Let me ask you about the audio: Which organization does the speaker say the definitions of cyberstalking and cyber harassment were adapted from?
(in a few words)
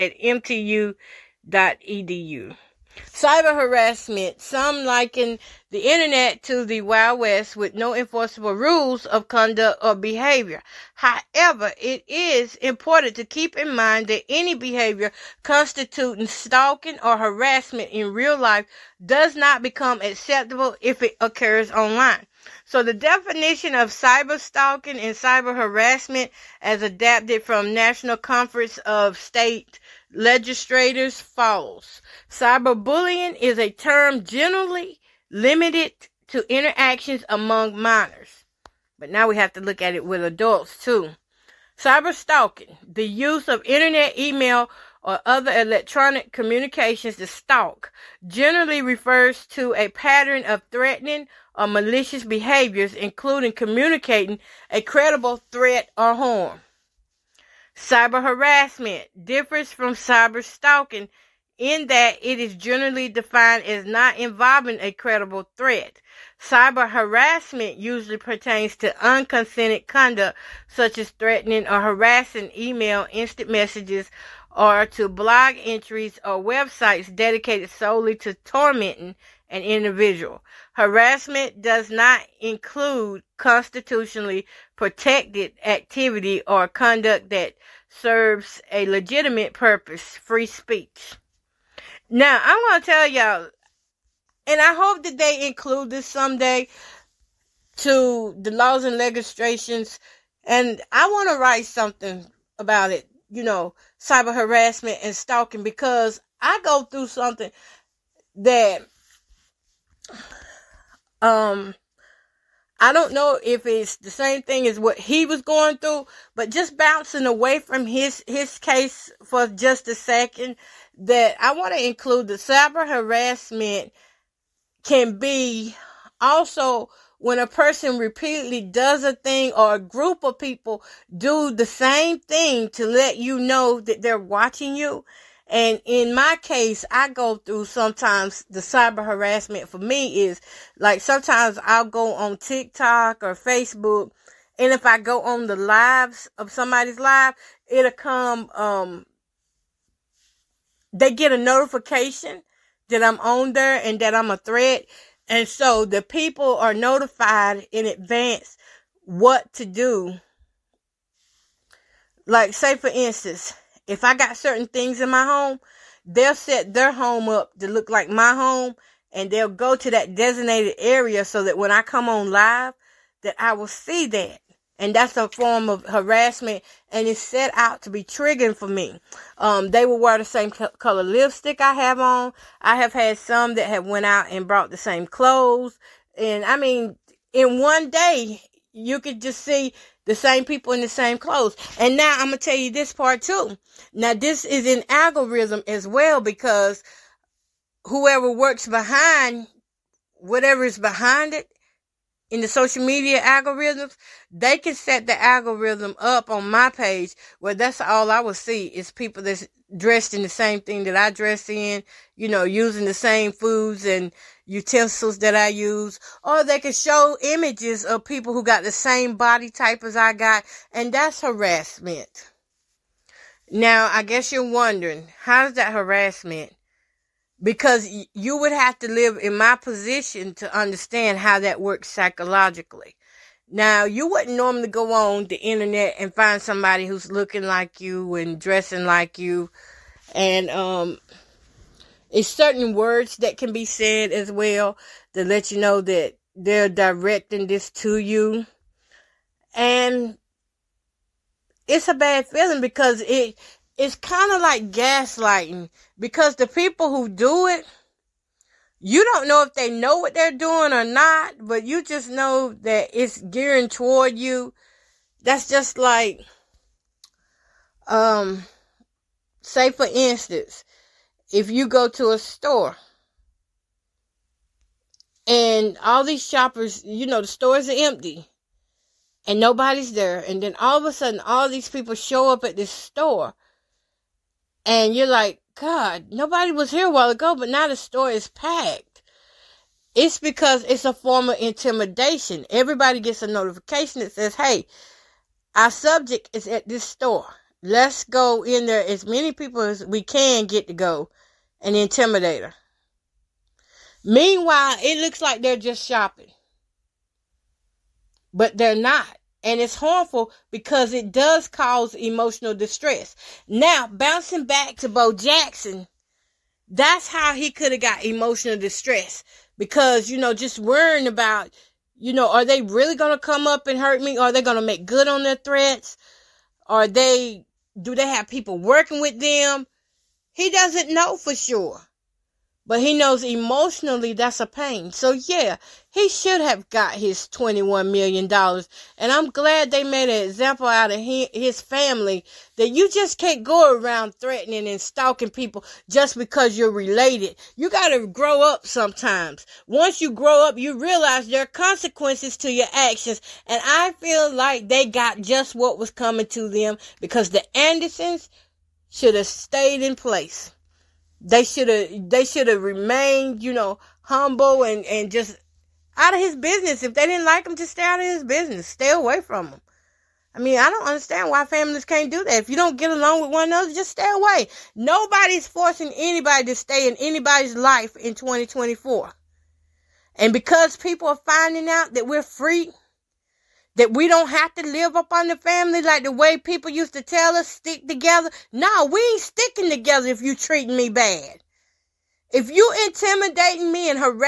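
National Conference of State Legislators.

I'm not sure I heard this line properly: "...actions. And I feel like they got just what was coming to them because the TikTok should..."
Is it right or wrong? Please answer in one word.
wrong.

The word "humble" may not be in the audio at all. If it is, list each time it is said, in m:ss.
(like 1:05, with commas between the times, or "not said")
6:04.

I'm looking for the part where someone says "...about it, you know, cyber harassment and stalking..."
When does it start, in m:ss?
1:42.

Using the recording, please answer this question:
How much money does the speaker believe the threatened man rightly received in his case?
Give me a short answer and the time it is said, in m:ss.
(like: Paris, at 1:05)
$21 million, at 5:37.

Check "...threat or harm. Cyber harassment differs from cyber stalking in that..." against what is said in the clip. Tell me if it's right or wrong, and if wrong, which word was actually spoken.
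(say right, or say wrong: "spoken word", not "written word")
right.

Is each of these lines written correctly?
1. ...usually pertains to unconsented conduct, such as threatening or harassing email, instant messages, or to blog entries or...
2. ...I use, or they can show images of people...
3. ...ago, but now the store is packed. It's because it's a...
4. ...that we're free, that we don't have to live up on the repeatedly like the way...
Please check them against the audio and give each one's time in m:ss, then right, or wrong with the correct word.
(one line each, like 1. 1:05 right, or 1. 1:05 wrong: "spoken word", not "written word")
1. 1:07 right
2. 3:35 right
3. 4:47 right
4. 6:21 wrong: "family", not "repeatedly".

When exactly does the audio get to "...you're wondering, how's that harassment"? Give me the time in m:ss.
3:44.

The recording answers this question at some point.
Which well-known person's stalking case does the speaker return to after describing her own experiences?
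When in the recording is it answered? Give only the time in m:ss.
5:14.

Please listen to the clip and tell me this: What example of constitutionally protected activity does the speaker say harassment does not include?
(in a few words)
Free speech.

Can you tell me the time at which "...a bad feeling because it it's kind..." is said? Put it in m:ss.
4:11.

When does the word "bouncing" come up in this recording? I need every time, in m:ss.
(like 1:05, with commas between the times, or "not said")
1:56, 5:13.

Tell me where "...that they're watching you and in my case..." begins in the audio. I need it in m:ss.
2:13.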